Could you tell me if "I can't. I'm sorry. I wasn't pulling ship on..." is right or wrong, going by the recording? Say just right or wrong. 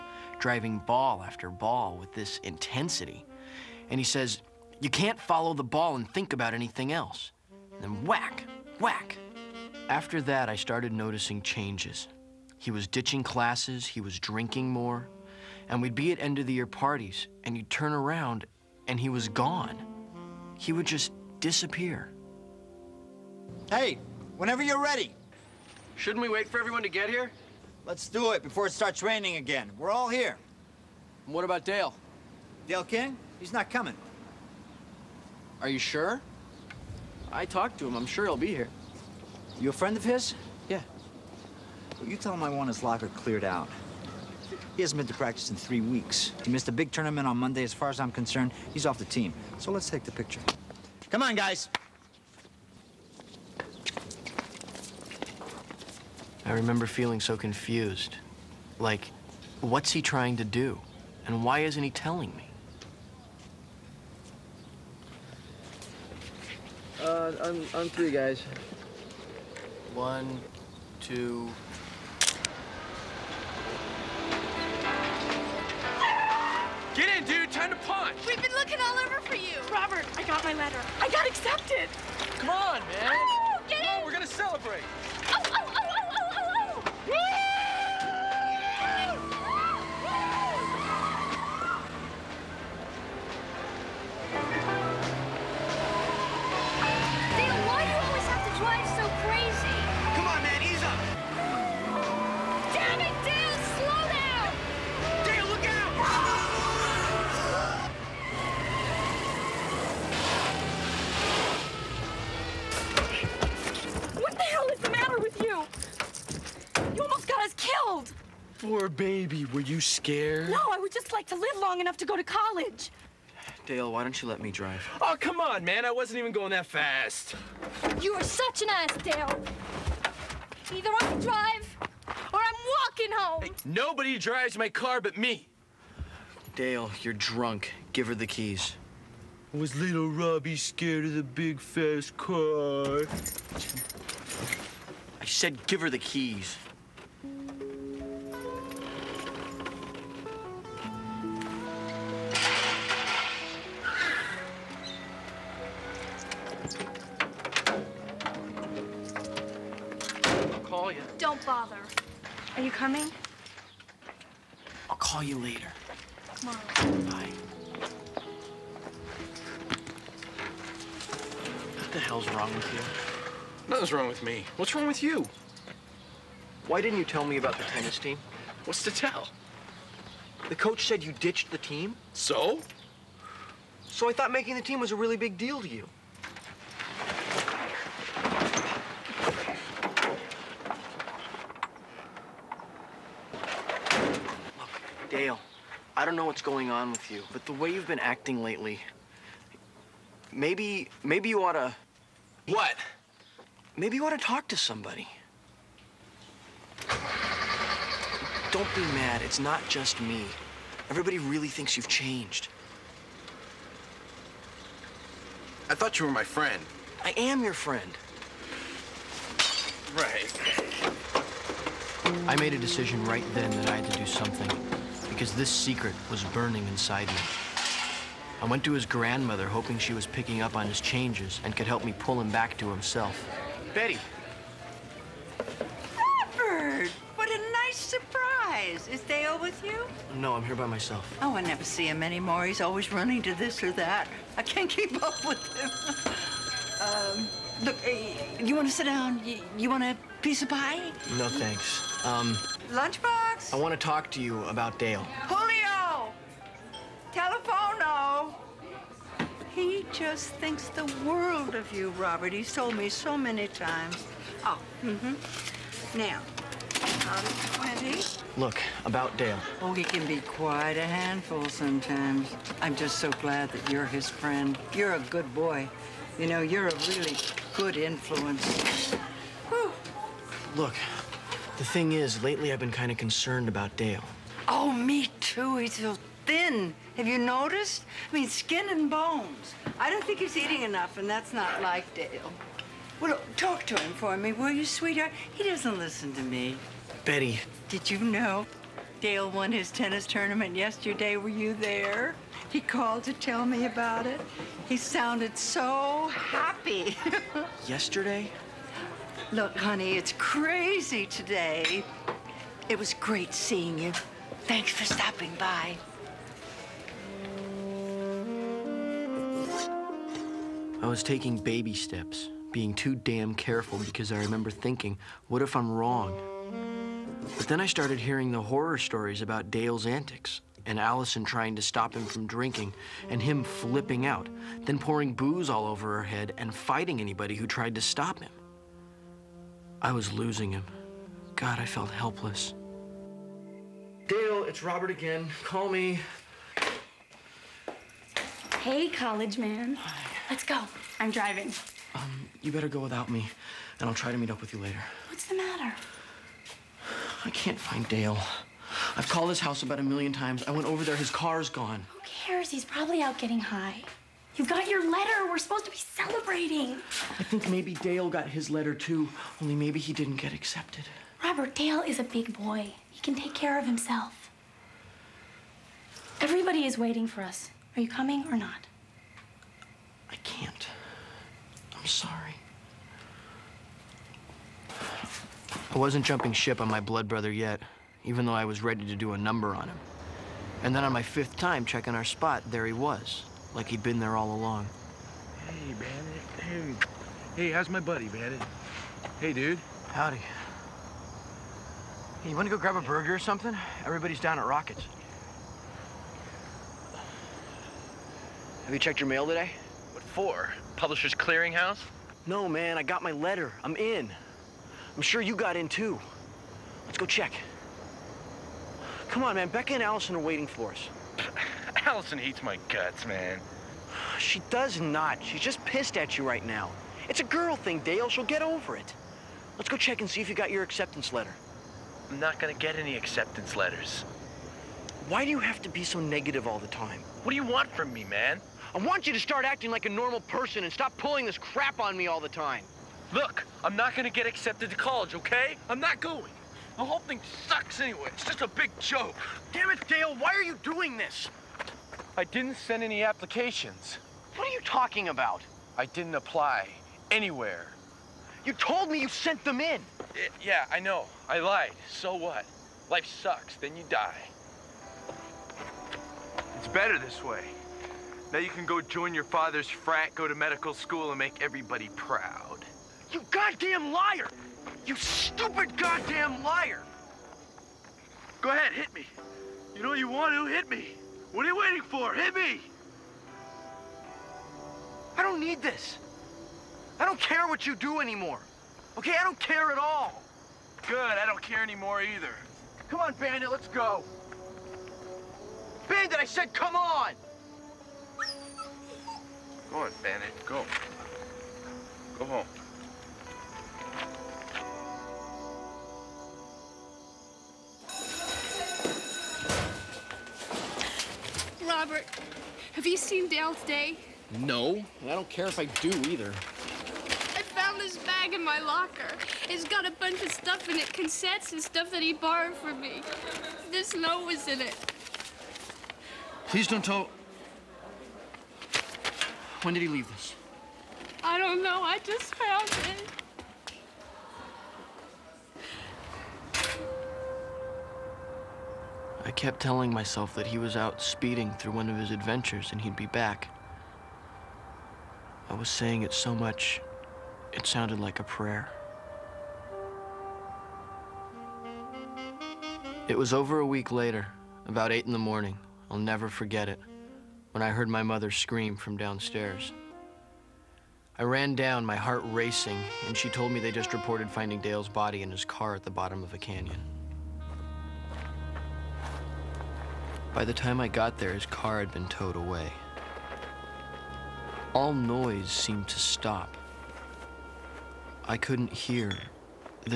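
wrong.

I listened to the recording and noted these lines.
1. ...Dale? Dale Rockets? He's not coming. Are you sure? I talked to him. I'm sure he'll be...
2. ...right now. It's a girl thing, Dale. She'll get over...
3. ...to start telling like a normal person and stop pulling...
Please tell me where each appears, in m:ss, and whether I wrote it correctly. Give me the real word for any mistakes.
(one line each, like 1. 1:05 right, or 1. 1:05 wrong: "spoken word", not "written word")
1. 0:31 wrong: "King", not "Rockets"
2. 7:06 right
3. 7:19 wrong: "acting", not "telling".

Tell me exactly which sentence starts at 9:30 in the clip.
By the time I got there, his car had been towed away.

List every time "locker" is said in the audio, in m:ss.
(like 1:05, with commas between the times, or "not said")
0:42, 8:38.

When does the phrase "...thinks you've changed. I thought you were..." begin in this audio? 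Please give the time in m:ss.
3:31.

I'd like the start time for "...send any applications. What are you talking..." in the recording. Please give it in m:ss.
7:32.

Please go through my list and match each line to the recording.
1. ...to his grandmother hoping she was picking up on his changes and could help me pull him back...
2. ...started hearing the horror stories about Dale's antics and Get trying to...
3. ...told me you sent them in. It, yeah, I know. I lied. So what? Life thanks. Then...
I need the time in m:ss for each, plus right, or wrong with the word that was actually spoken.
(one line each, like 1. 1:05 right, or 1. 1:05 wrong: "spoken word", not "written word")
1. 3:48 right
2. 5:27 wrong: "Allison", not "Get"
3. 7:38 wrong: "sucks", not "thanks".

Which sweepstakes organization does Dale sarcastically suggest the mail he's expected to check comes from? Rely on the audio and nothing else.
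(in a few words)
Publisher's Clearinghouse.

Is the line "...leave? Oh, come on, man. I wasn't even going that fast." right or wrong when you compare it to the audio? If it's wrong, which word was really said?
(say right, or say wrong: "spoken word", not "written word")
wrong: "drive", not "leave".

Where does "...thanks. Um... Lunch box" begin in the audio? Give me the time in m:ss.
4:11.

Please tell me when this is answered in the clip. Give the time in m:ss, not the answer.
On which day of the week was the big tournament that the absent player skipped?
0:47.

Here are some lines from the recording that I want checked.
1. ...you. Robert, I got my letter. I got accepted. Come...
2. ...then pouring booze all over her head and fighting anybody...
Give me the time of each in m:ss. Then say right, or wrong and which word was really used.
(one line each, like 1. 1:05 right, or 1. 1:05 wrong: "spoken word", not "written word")
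1. 1:19 right
2. 5:34 right.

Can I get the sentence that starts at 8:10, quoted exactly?
Good, I don't care anymore either.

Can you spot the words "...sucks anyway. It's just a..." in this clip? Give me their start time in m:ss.
7:27.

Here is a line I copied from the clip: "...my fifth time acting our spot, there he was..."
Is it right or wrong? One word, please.
wrong.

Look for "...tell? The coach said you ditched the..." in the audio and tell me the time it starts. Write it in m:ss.
2:58.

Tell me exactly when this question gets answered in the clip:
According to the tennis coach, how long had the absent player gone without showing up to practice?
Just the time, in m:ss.
0:45.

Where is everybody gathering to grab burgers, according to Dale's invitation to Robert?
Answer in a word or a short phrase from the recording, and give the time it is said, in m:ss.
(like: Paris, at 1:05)
Rockets, at 6:44.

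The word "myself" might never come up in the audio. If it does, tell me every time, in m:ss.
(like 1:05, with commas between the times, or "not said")
4:00, 8:59.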